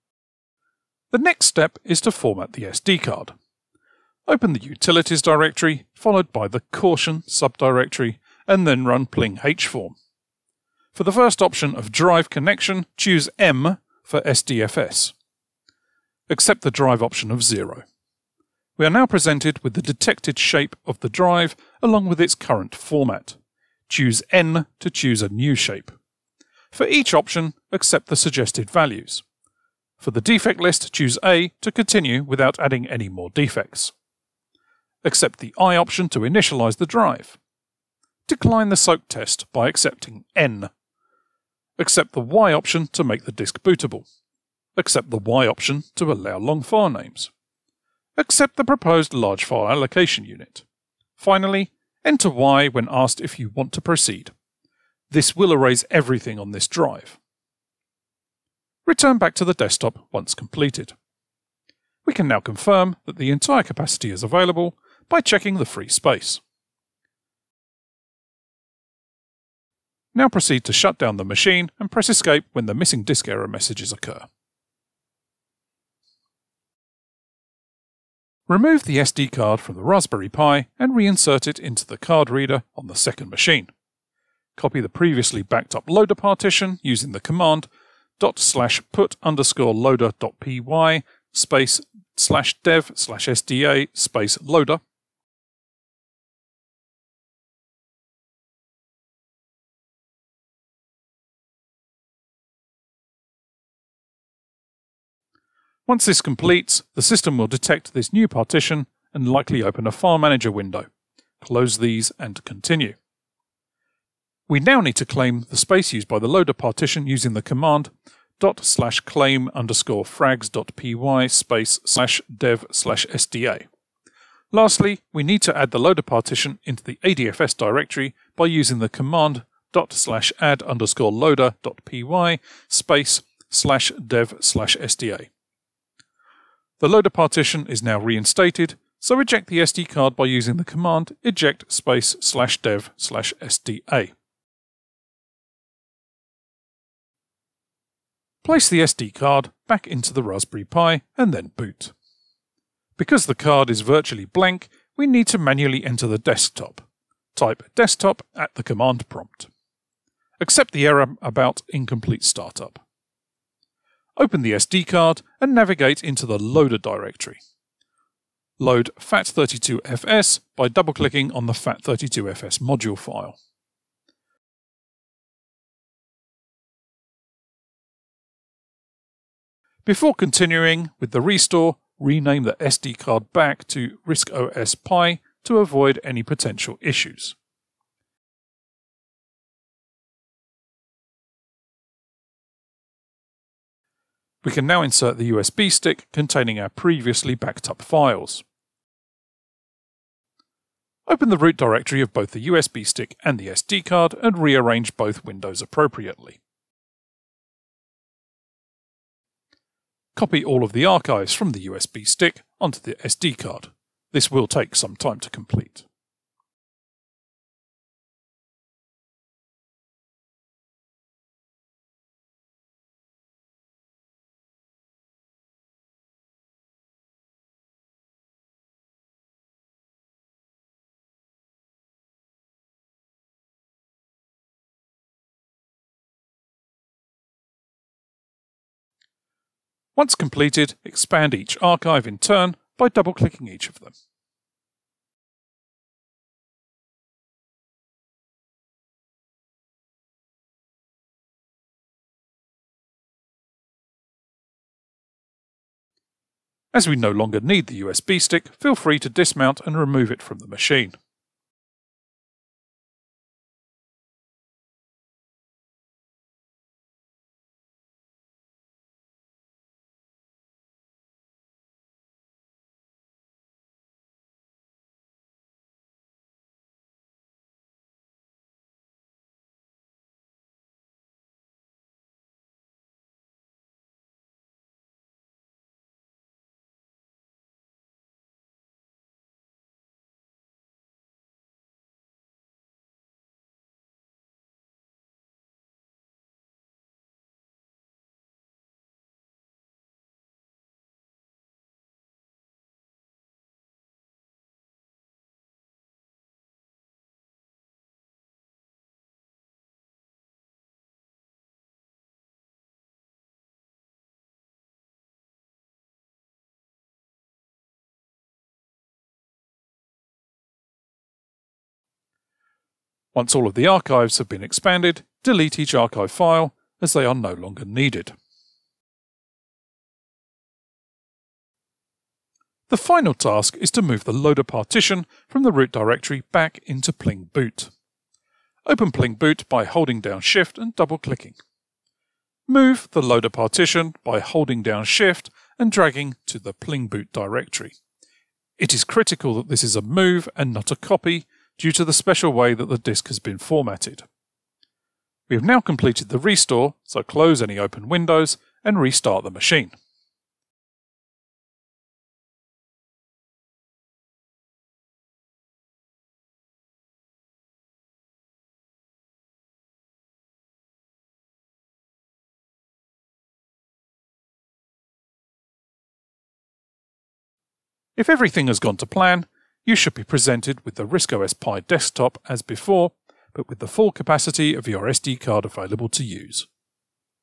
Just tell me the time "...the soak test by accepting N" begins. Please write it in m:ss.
0:38.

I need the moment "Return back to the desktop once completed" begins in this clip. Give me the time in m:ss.
0:58.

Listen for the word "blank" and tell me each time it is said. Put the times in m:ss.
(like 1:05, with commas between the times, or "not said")
2:34.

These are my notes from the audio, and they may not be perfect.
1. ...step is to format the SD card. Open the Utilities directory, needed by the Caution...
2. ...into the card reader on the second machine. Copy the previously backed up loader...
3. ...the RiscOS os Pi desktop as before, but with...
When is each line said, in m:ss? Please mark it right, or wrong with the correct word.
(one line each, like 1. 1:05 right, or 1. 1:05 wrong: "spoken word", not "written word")
1. 0:01 wrong: "followed", not "needed"
2. 1:21 right
3. 6:20 right.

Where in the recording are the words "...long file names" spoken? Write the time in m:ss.
0:46.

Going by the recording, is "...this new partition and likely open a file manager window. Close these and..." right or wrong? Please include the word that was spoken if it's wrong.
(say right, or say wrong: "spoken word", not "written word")
right.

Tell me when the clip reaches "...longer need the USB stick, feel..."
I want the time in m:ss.
4:17.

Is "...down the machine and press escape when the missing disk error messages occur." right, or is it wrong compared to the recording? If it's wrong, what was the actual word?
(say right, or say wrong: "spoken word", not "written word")
right.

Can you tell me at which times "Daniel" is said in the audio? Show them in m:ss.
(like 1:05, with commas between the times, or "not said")
not said.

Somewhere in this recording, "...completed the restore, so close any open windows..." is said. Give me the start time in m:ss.
5:55.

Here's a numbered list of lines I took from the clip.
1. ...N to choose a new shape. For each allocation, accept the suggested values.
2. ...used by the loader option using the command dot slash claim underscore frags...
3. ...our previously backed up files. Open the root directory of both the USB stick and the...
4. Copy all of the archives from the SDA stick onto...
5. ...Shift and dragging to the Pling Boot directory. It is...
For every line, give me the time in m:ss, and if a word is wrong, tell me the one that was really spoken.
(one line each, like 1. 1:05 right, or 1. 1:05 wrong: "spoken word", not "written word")
1. 0:24 wrong: "option", not "allocation"
2. 1:55 wrong: "partition", not "option"
3. 3:16 right
4. 3:30 wrong: "USB", not "SDA"
5. 5:44 right.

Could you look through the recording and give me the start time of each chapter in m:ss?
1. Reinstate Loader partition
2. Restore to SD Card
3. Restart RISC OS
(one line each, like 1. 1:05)
1. 1:19
2. 2:30
3. 5:59.